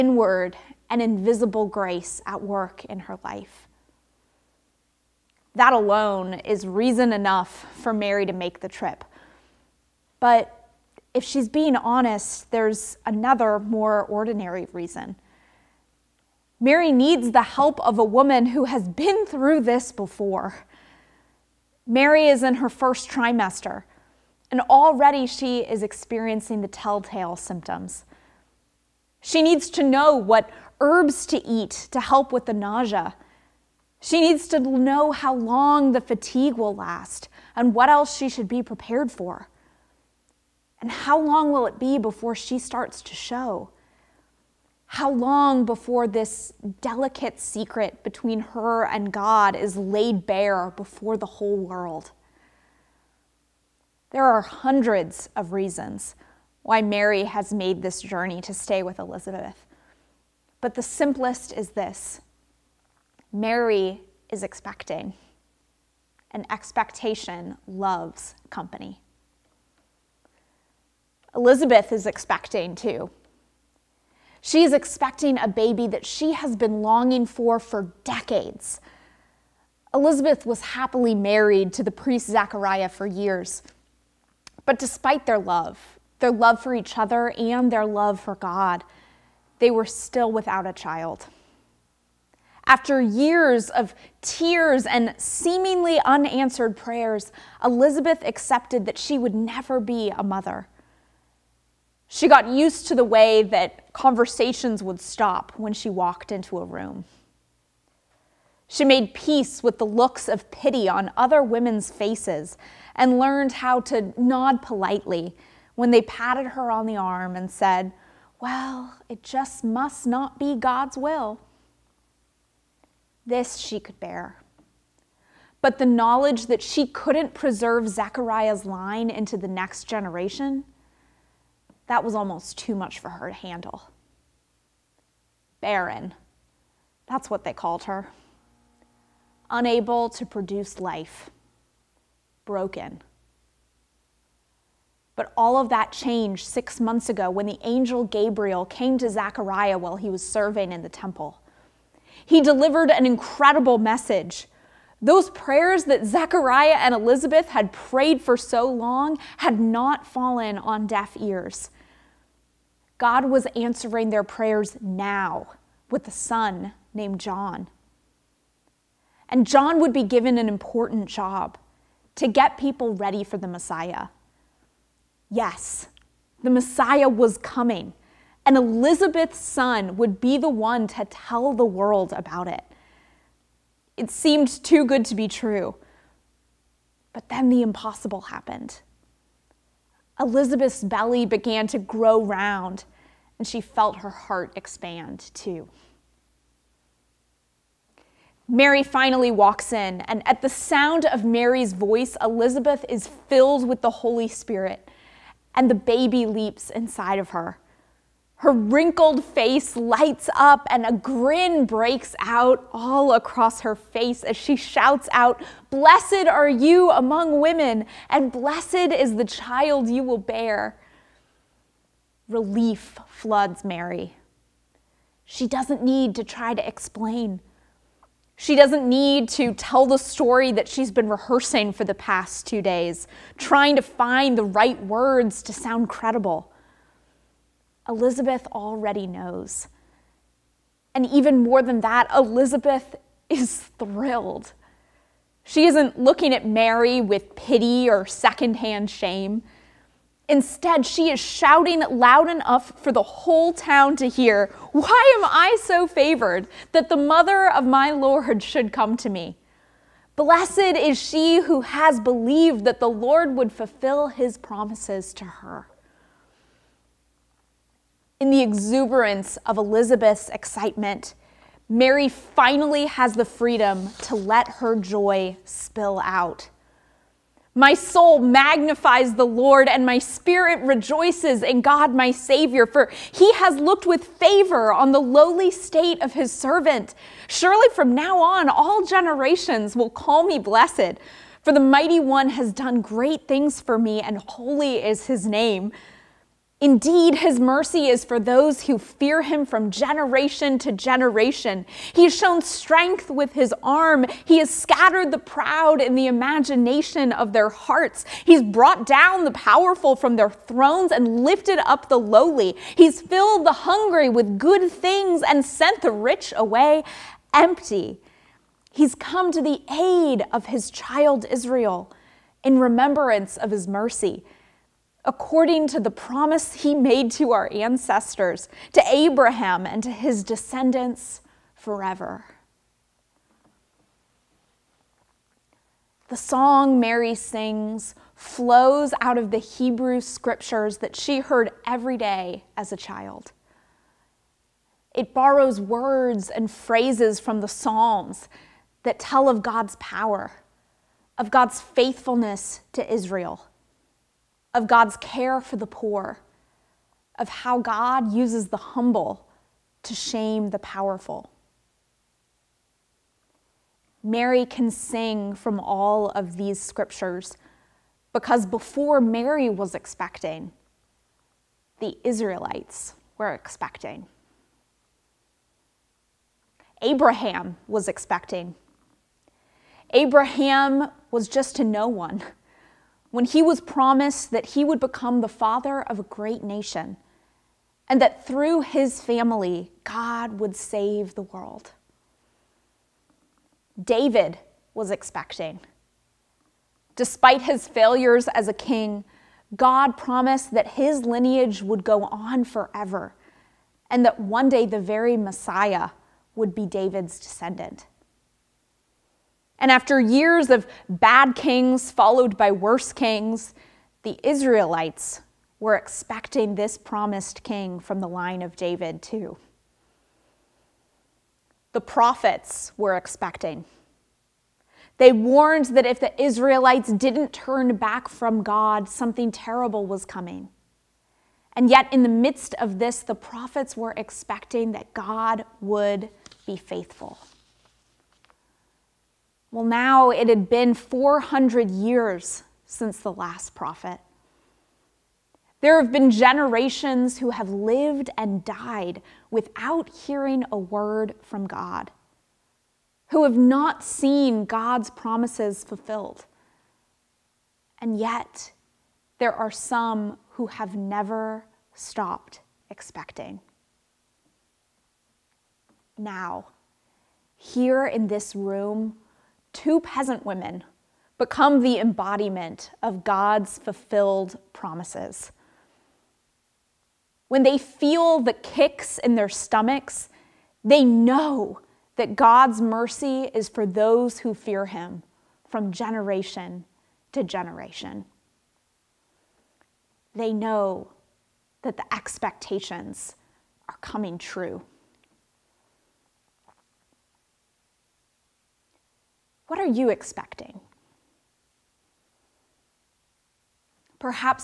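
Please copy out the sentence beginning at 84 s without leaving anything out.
But despite their love, their love for each other and their love for God, they were still without a child.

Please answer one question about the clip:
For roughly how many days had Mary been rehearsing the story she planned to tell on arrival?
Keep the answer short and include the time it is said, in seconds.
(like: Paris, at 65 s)
2, at 232 s.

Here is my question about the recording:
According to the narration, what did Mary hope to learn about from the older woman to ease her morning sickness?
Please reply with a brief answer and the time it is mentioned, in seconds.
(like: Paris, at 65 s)
herbs, at 30 s.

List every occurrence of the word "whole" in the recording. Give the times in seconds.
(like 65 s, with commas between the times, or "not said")
51 s, 253 s.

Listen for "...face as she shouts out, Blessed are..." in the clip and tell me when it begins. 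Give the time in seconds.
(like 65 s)
213 s.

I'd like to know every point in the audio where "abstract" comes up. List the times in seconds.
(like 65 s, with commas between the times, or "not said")
not said.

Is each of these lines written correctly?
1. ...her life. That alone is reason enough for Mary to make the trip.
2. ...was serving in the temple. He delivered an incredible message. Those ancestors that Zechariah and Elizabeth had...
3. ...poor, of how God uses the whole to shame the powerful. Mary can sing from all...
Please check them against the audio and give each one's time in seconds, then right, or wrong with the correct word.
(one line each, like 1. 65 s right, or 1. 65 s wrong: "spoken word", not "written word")
1. 2 s right
2. 150 s wrong: "prayers", not "ancestors"
3. 355 s wrong: "humble", not "whole".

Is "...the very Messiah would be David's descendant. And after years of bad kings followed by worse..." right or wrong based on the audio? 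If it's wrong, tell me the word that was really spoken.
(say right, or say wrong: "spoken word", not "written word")
right.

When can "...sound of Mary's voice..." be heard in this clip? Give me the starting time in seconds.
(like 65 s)
200 s.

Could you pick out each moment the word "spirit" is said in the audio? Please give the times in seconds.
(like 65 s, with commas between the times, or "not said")
204 s, 279 s.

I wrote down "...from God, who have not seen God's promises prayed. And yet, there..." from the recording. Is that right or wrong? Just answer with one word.
wrong.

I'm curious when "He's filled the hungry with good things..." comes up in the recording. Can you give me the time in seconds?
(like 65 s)
312 s.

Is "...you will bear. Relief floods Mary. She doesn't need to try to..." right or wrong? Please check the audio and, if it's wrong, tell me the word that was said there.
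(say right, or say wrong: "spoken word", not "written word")
right.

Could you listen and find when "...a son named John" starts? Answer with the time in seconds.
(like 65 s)
166 s.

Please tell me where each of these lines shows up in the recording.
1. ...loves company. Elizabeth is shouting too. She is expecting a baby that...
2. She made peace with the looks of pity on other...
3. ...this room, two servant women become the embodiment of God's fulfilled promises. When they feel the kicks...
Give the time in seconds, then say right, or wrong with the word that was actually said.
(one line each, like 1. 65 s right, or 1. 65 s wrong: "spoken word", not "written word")
1. 67 s wrong: "expecting", not "shouting"
2. 108 s right
3. 468 s wrong: "peasant", not "servant".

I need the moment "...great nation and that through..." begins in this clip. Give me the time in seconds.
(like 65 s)
386 s.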